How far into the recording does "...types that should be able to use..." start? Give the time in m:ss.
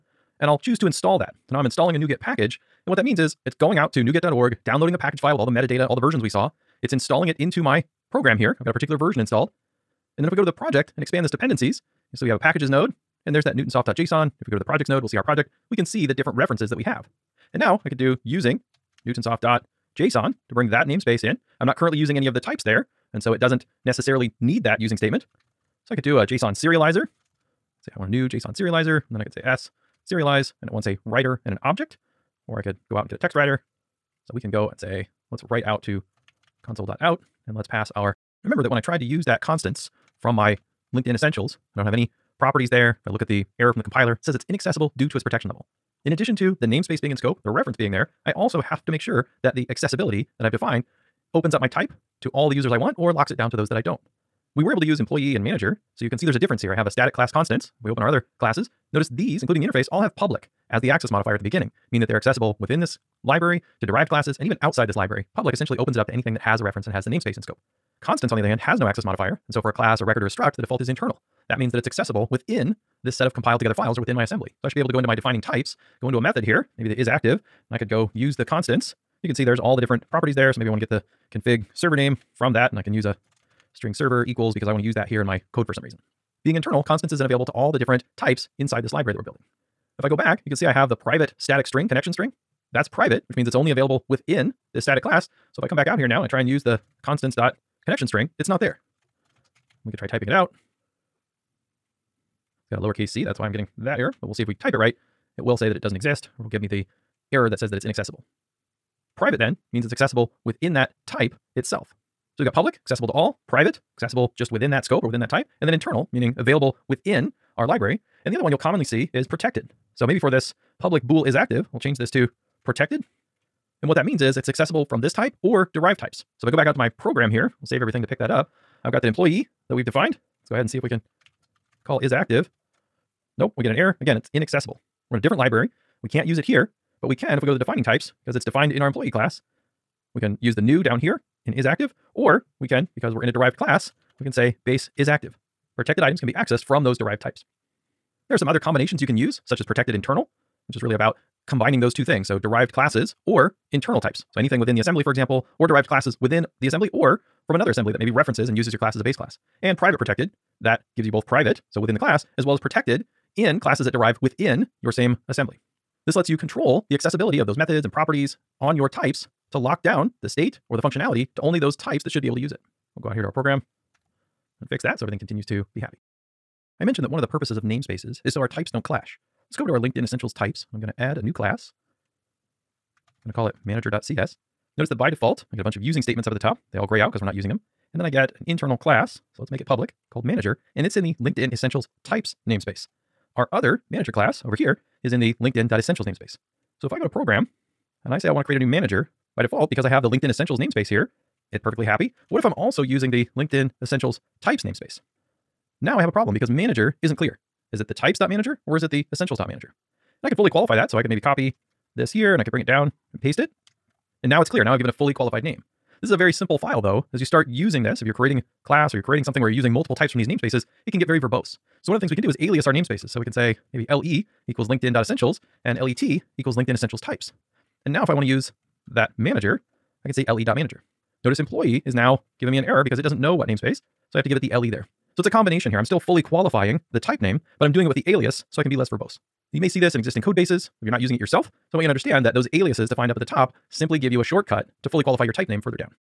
2:51.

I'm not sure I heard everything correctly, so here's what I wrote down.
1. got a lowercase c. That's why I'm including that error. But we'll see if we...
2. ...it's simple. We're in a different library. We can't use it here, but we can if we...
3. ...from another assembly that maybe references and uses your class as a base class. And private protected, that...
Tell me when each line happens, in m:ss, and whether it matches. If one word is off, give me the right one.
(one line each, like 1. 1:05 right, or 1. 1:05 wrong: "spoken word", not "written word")
1. 1:42 wrong: "getting", not "including"
2. 2:14 wrong: "inaccessible", not "simple"
3. 2:37 right.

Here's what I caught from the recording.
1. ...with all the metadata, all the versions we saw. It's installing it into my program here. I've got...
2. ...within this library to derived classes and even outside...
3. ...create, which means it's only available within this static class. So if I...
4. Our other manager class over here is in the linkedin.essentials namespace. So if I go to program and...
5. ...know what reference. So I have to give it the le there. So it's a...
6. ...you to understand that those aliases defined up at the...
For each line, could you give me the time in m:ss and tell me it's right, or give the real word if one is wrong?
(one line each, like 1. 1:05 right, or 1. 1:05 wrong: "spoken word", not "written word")
1. 0:05 right
2. 1:02 right
3. 1:32 wrong: "private", not "create"
4. 3:13 right
5. 3:53 wrong: "namespace", not "reference"
6. 4:01 right.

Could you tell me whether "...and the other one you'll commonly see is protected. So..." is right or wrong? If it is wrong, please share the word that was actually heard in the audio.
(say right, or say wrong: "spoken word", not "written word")
right.